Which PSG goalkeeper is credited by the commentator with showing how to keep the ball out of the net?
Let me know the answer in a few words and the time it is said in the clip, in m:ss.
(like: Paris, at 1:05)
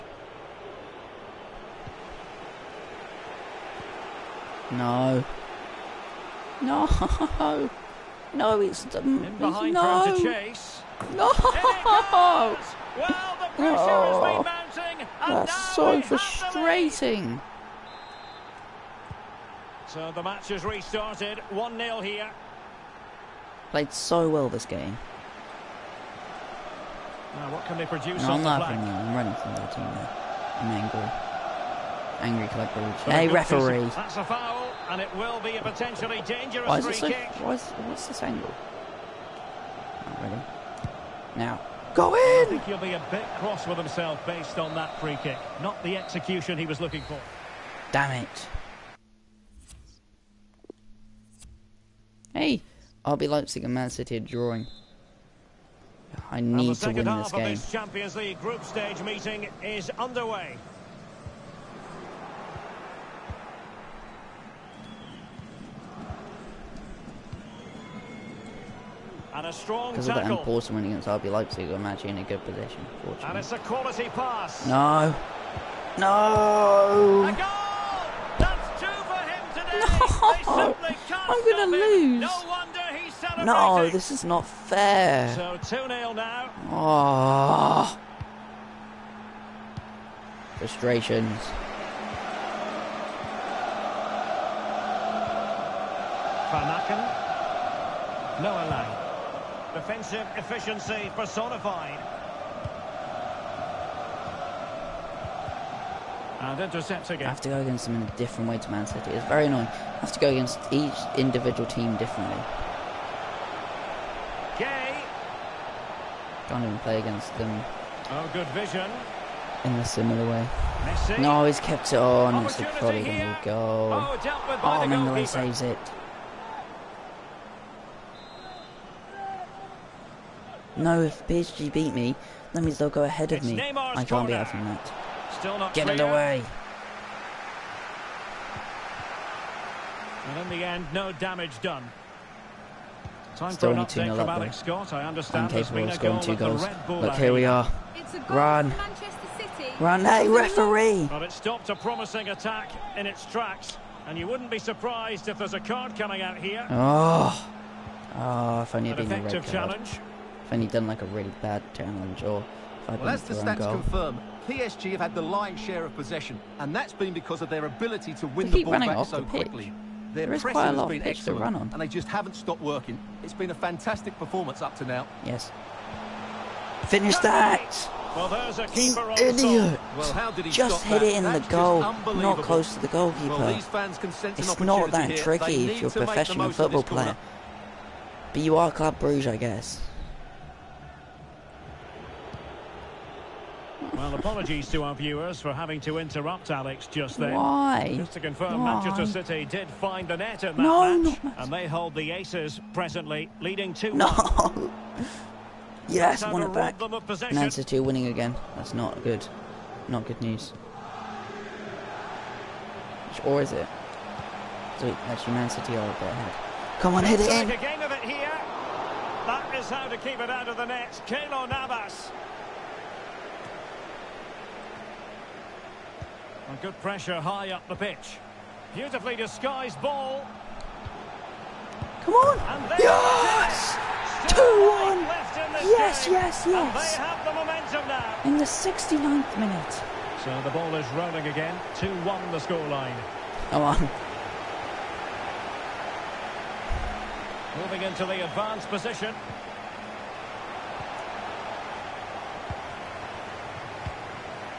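Keylor Navas, at 3:41.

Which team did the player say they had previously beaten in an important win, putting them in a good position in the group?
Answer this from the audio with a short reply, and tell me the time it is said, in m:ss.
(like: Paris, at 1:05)
RB Leipzig, at 1:11.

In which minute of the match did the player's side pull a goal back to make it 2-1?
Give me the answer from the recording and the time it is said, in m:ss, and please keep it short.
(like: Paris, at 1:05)
69th minute, at 3:58.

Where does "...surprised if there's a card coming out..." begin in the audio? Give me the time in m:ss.
2:34.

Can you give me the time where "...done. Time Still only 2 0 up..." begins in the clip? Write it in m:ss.
2:21.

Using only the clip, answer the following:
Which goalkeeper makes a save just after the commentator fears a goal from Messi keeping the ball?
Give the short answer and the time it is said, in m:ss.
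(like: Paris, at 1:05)
Mignolet, at 2:04.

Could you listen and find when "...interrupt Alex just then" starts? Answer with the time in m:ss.
3:15.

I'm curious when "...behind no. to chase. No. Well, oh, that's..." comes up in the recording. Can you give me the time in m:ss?
0:09.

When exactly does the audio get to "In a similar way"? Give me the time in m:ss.
1:59.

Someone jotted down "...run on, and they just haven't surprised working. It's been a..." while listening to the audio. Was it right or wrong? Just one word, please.
wrong.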